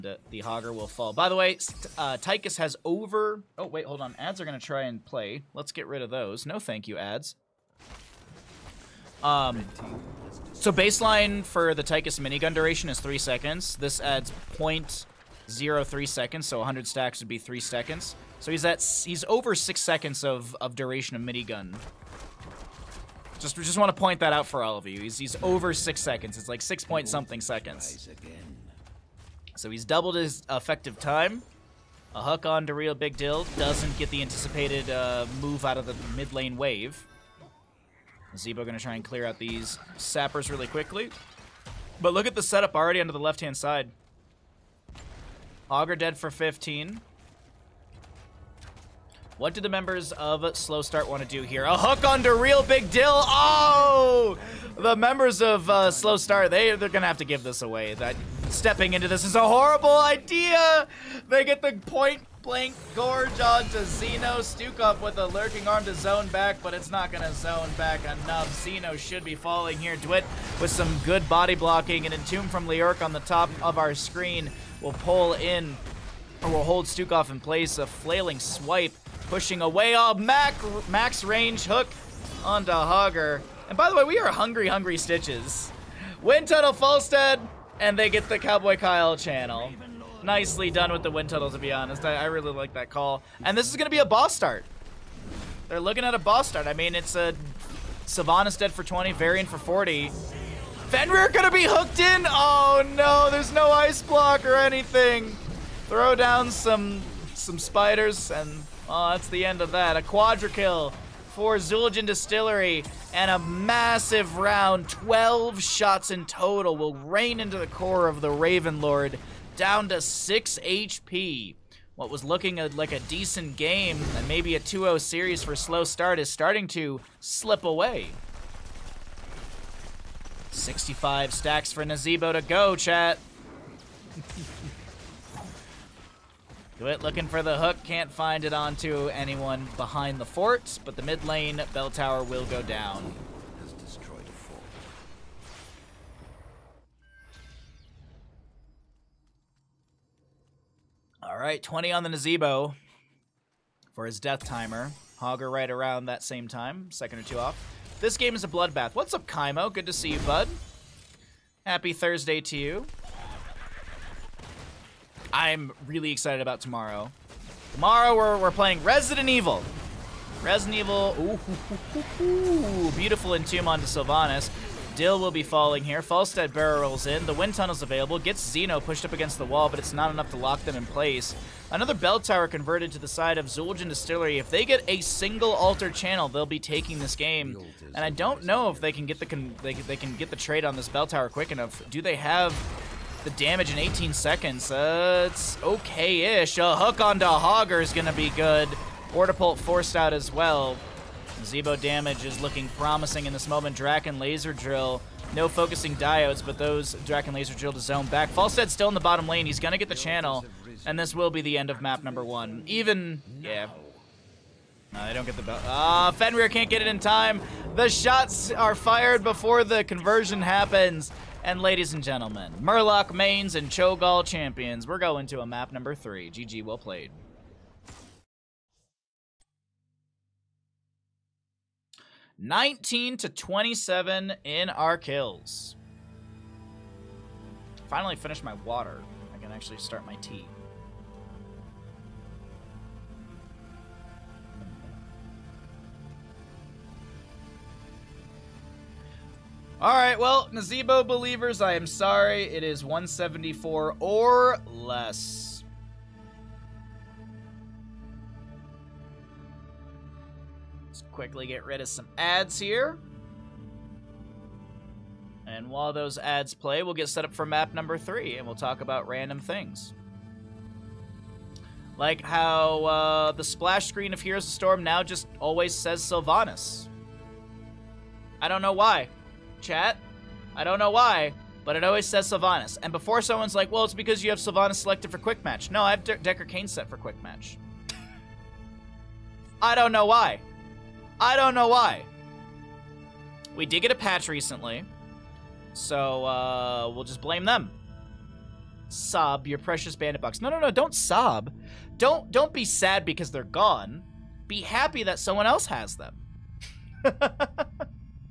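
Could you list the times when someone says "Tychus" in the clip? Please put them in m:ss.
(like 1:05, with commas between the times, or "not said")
0:02, 0:11.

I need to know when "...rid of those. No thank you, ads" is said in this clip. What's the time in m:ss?
0:05.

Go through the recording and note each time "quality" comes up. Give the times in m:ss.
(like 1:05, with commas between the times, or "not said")
not said.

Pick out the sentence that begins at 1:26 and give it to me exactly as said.
Wind Tunnel Falstad, and they get the Cowboy Kyle channel nicely done with the wind tunnel, to be honest.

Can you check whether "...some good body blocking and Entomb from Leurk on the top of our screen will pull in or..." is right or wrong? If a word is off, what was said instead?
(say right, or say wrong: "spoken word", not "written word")
right.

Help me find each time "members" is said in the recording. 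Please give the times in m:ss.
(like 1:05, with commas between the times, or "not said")
0:49, 0:54.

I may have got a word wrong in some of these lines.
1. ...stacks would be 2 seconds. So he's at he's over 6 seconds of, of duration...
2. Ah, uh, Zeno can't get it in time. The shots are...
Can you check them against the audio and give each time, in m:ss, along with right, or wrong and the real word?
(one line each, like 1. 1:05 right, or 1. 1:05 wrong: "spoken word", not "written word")
1. 0:16 wrong: "3", not "2"
2. 3:35 wrong: "Fenrir", not "Zeno".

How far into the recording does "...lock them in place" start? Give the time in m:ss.
3:00.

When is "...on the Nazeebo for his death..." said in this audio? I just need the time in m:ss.
2:31.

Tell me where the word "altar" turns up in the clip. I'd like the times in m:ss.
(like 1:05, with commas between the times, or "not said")
3:05.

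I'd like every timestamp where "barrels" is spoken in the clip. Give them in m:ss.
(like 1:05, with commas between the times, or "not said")
2:56.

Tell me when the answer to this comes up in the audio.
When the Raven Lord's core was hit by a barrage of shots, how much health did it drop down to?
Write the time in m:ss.
1:59.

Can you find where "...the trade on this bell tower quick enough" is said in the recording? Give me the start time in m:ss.
3:10.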